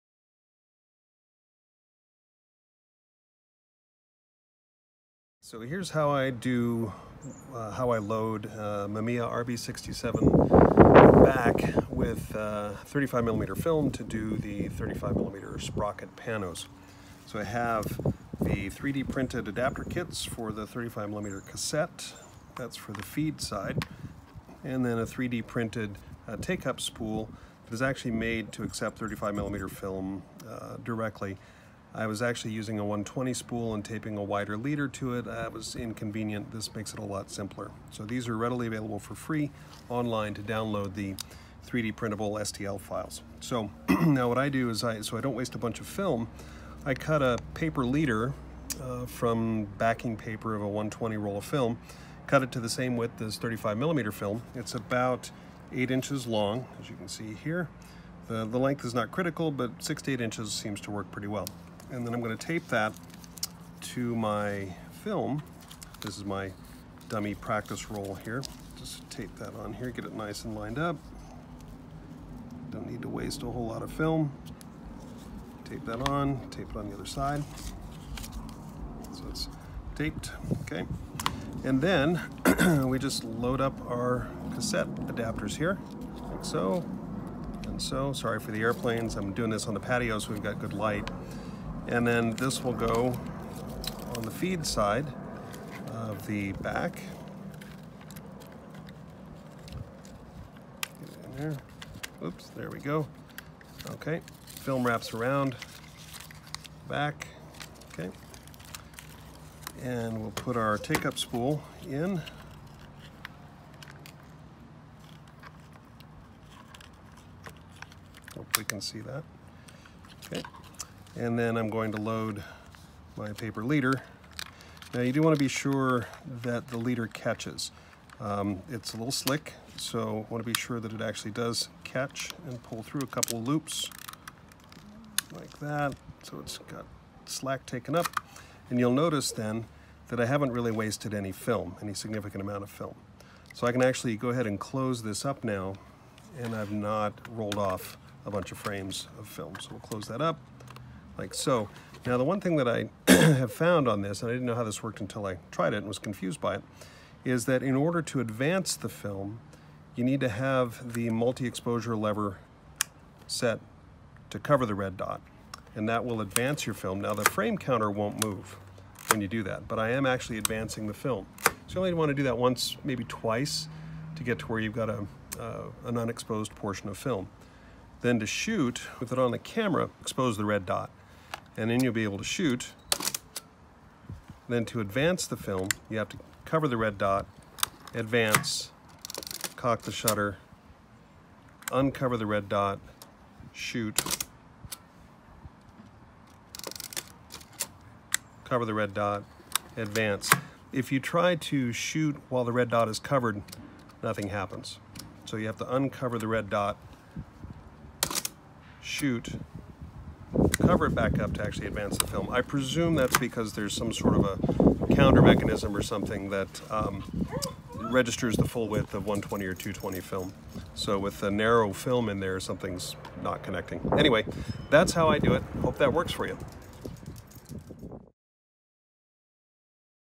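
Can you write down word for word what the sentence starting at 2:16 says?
So it's got slack taken up.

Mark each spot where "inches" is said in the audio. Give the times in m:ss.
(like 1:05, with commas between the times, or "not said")
0:55, 1:00.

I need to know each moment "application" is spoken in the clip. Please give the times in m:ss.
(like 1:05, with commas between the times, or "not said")
not said.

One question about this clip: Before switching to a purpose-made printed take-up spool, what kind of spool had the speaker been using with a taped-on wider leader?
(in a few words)
120 spool.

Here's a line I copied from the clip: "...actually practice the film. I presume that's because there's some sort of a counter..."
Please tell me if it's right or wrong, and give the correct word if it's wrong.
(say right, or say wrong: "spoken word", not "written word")
wrong: "advance", not "practice".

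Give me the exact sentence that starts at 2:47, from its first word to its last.
Now the frame counter won't move when you do that, but I am actually advancing the film.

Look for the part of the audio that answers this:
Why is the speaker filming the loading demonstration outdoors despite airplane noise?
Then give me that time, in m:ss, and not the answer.
1:30.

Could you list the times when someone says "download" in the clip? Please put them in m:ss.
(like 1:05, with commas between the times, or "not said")
0:40.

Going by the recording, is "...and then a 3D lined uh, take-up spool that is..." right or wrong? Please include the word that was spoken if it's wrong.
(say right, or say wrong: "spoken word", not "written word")
wrong: "printed", not "lined".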